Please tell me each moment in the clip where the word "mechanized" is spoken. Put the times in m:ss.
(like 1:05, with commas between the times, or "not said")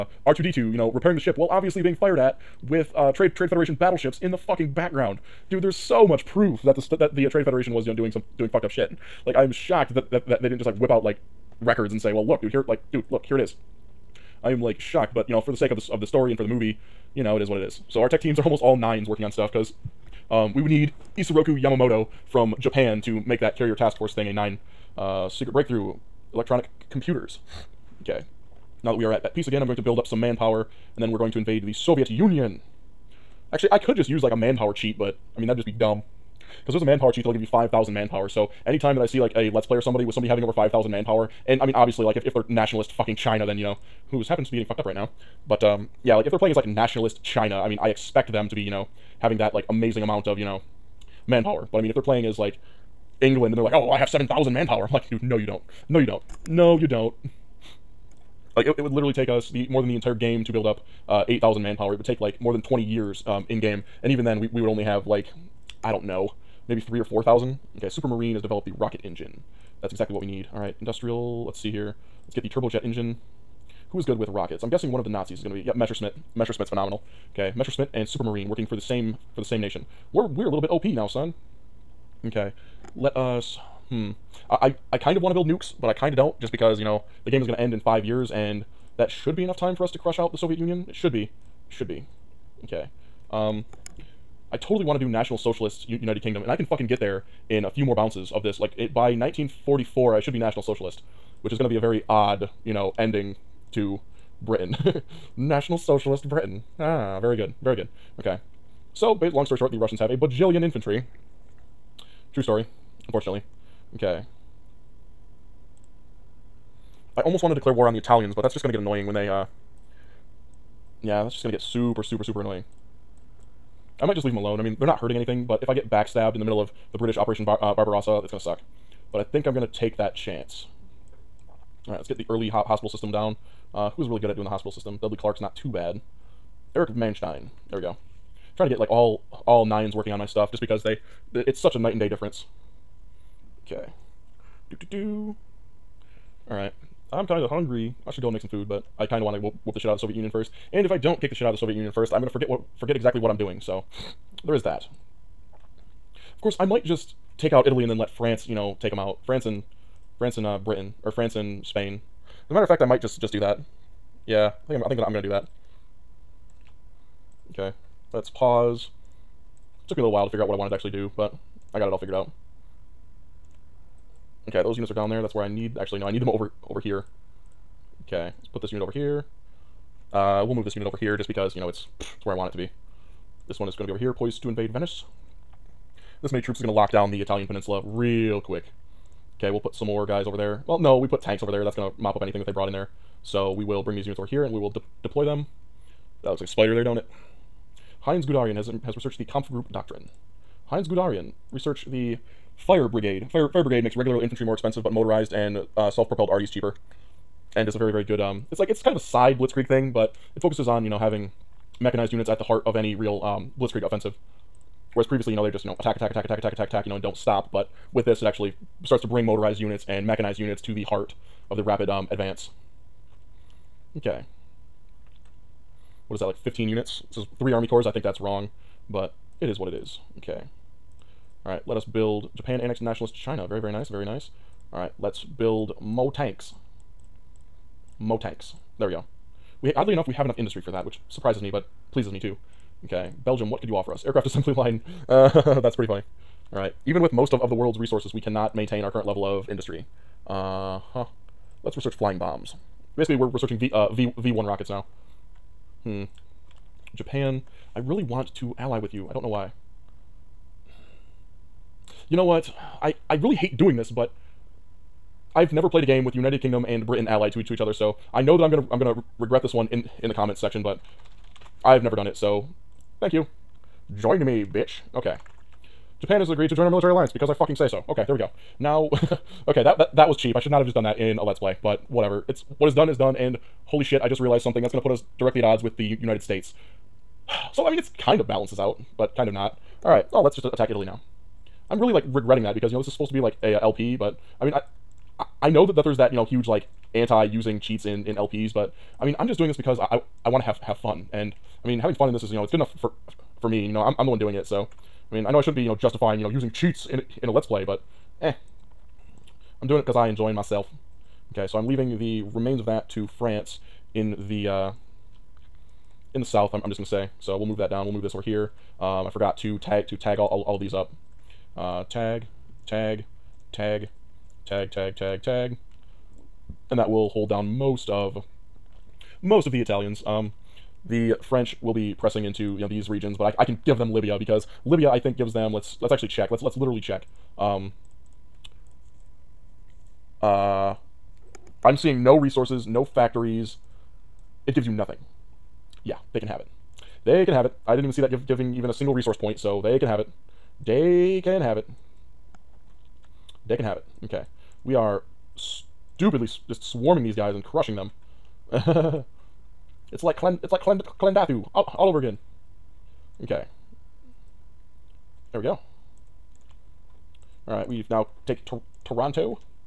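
3:31, 3:40.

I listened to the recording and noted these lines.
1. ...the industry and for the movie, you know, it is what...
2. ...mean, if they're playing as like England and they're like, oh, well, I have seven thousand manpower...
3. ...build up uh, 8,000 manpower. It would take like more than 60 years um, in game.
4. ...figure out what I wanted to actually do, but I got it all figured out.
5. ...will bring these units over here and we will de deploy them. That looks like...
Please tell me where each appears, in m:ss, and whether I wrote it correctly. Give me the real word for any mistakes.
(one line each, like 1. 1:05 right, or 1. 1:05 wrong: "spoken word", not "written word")
1. 0:16 wrong: "story", not "industry"
2. 0:51 right
3. 1:00 wrong: "20", not "60"
4. 2:50 right
5. 3:13 right.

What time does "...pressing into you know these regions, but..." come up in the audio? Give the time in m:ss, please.
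5:31.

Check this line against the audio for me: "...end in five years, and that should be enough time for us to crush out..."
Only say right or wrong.
right.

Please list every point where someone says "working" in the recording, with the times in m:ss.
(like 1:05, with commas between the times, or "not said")
0:19, 1:18, 2:19.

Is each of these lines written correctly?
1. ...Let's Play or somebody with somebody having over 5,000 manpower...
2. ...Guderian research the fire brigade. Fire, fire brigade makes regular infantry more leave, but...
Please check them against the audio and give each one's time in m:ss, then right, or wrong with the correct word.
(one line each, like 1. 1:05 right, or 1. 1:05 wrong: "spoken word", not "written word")
1. 0:39 right
2. 3:20 wrong: "expensive", not "leave".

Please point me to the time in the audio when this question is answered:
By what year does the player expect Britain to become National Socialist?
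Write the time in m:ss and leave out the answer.
1:39.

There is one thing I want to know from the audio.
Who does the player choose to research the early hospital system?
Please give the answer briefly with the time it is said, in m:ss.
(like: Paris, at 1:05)
Erich Manstein, at 2:16.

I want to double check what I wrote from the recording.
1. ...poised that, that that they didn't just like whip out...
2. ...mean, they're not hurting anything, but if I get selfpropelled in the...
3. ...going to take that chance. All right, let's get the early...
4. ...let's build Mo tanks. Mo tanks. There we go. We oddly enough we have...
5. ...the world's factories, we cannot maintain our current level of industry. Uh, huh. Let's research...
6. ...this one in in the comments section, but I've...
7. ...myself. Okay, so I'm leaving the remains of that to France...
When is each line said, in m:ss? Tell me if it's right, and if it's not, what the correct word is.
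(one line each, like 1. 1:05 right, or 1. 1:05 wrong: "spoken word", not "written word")
1. 0:09 wrong: "shocked", not "poised"
2. 2:04 wrong: "backstabbed", not "selfpropelled"
3. 2:09 right
4. 3:54 right
5. 4:07 wrong: "resources", not "factories"
6. 4:29 right
7. 5:10 right.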